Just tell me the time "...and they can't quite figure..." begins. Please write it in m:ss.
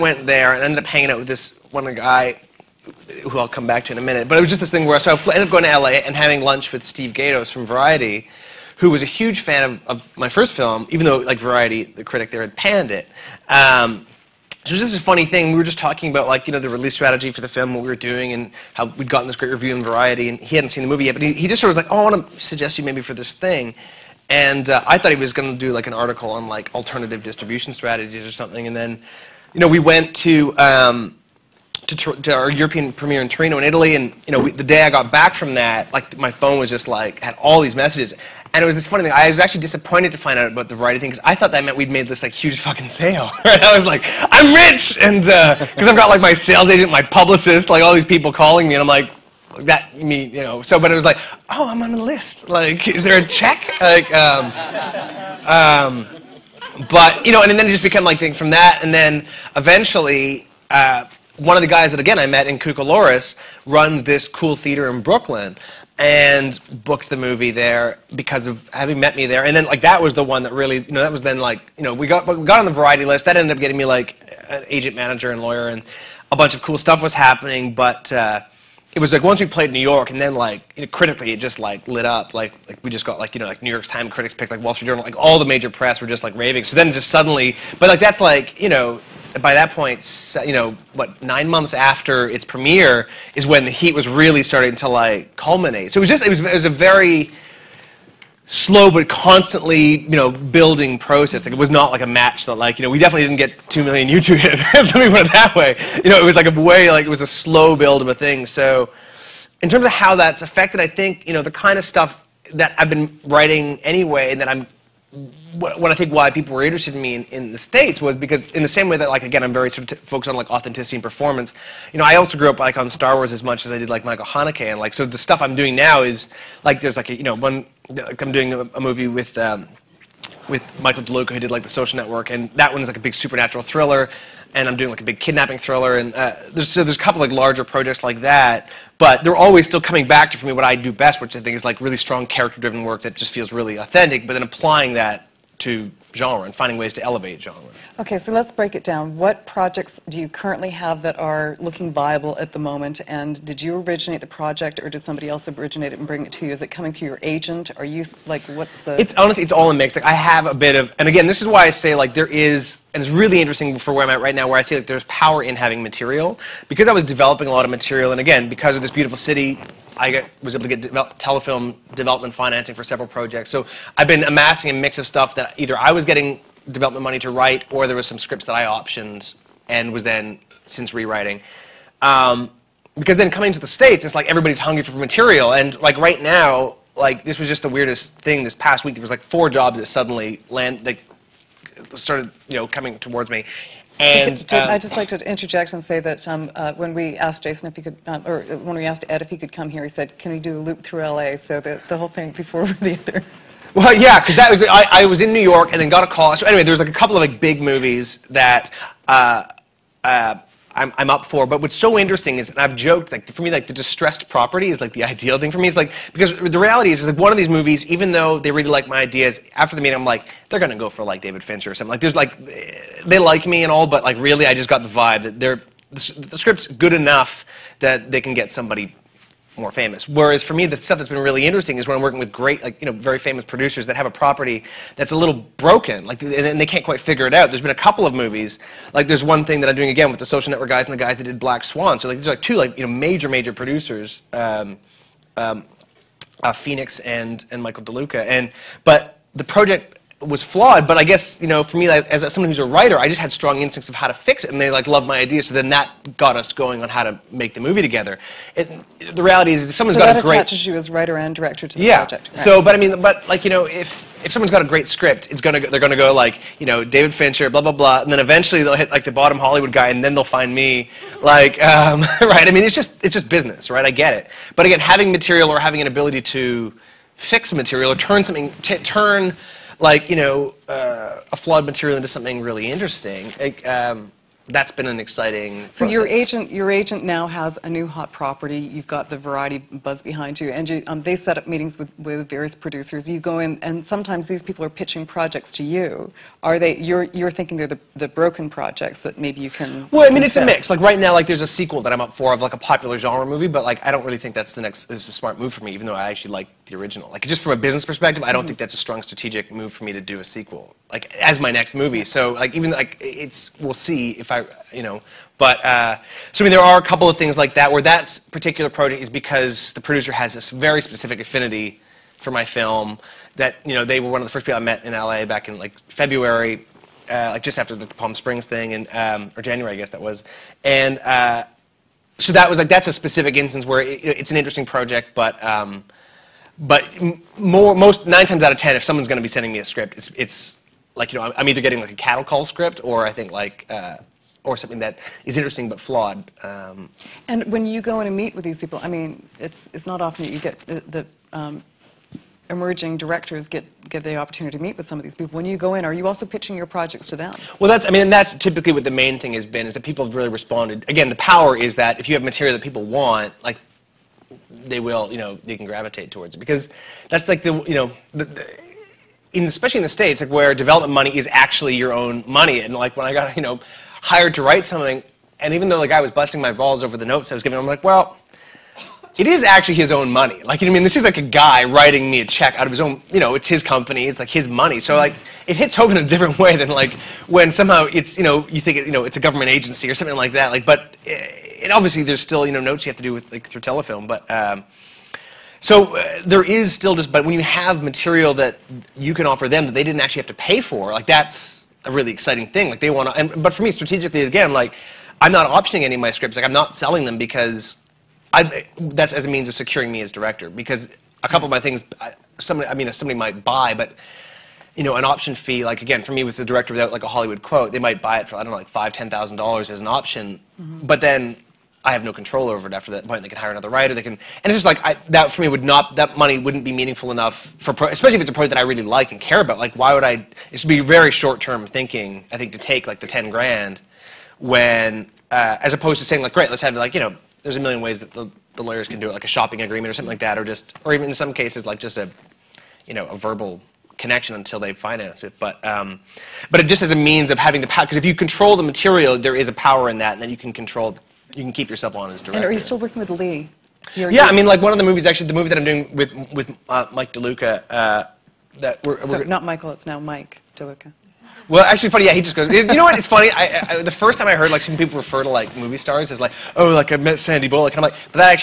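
3:56.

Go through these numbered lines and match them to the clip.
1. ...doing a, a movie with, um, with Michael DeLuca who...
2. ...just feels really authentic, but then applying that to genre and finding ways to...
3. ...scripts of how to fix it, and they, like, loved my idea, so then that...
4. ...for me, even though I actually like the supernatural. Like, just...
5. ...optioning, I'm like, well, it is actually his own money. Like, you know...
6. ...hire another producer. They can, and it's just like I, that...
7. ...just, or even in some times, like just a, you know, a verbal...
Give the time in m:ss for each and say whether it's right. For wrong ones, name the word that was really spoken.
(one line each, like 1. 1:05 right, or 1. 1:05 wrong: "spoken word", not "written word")
1. 2:08 right
2. 2:23 right
3. 4:13 wrong: "instincts", not "scripts"
4. 5:05 wrong: "original", not "supernatural"
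5. 6:17 wrong: "giving", not "optioning"
6. 7:03 wrong: "writer", not "producer"
7. 7:20 wrong: "cases", not "times".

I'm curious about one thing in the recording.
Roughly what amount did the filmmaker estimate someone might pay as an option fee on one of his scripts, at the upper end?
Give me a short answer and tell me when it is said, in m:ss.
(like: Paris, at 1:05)
$10,000, at 6:58.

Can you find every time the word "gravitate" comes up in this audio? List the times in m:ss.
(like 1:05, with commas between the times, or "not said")
6:05.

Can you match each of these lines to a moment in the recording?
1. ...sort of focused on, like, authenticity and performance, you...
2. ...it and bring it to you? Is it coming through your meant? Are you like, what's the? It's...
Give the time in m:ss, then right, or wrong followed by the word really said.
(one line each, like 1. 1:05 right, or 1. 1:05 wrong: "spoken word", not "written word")
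1. 1:59 right
2. 2:35 wrong: "agent", not "meant".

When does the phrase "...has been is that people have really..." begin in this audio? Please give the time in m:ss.
5:59.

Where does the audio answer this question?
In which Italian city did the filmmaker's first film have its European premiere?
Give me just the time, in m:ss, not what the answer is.
0:33.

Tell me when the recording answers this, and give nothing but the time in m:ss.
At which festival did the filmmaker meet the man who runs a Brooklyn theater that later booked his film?
1:02.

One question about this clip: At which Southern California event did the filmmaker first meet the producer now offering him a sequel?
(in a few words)
Palm Springs.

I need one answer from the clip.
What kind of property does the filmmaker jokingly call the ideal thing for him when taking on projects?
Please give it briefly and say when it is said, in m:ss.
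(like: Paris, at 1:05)
distressed property, at 3:33.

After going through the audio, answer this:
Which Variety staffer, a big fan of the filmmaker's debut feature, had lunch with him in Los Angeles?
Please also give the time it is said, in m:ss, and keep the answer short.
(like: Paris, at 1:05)
Steve Gaydos, at 0:06.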